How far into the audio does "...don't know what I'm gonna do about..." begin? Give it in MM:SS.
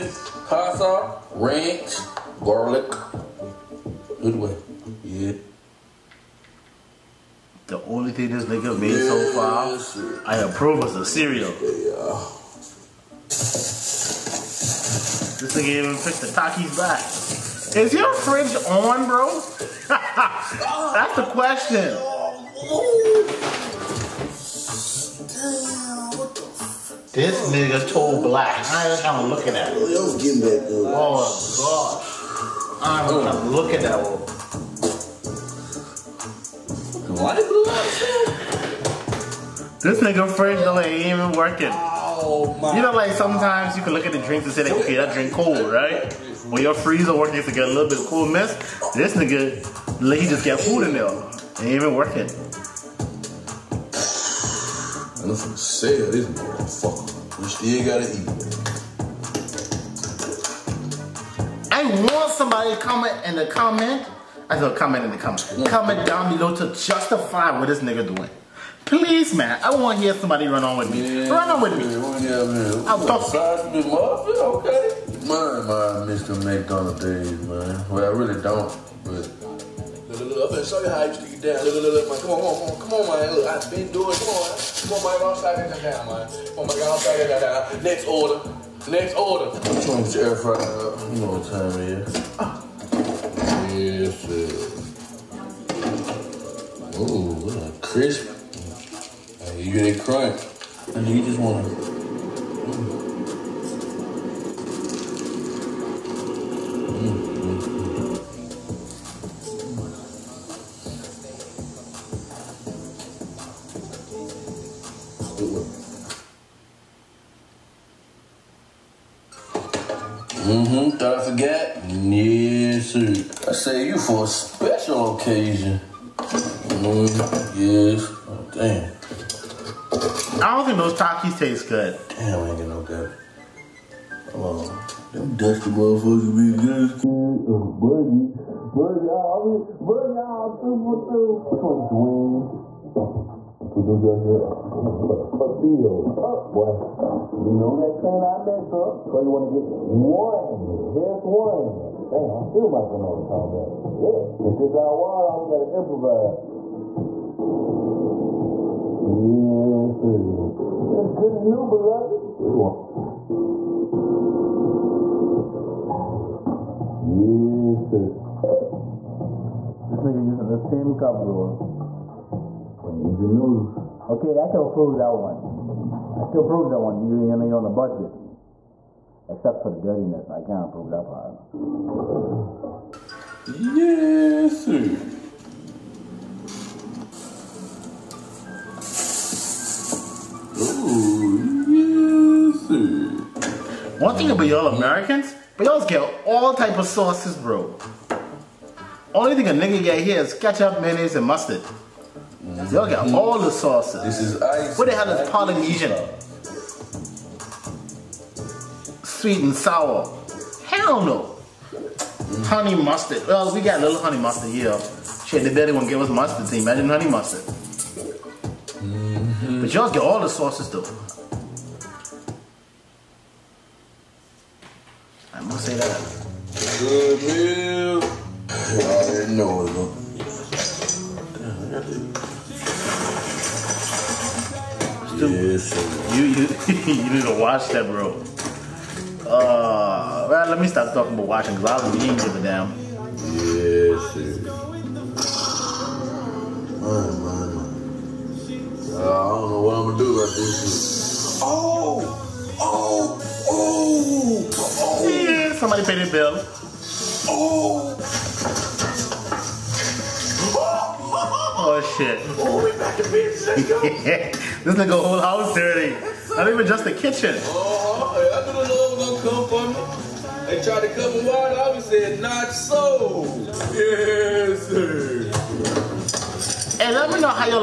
04:09.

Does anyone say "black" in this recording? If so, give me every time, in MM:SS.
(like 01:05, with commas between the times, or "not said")
00:28.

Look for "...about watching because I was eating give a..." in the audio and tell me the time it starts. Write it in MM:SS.
04:01.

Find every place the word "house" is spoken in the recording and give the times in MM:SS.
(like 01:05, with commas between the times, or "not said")
04:25.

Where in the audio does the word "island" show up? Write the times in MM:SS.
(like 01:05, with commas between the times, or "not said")
not said.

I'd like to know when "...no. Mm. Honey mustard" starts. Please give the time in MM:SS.
03:31.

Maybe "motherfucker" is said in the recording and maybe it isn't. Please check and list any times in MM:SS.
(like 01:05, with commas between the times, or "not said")
00:56, 02:15.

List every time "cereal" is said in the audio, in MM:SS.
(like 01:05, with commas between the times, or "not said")
00:11.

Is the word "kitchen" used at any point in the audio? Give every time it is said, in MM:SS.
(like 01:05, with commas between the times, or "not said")
04:26.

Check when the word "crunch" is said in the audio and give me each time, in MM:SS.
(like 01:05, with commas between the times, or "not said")
01:40.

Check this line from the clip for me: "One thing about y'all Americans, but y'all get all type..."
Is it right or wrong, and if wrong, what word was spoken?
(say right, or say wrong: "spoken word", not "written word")
right.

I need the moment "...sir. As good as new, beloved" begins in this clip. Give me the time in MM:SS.
02:40.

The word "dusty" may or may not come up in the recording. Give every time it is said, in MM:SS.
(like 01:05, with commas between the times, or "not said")
02:15, 02:23.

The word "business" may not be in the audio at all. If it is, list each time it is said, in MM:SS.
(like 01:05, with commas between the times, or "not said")
04:23.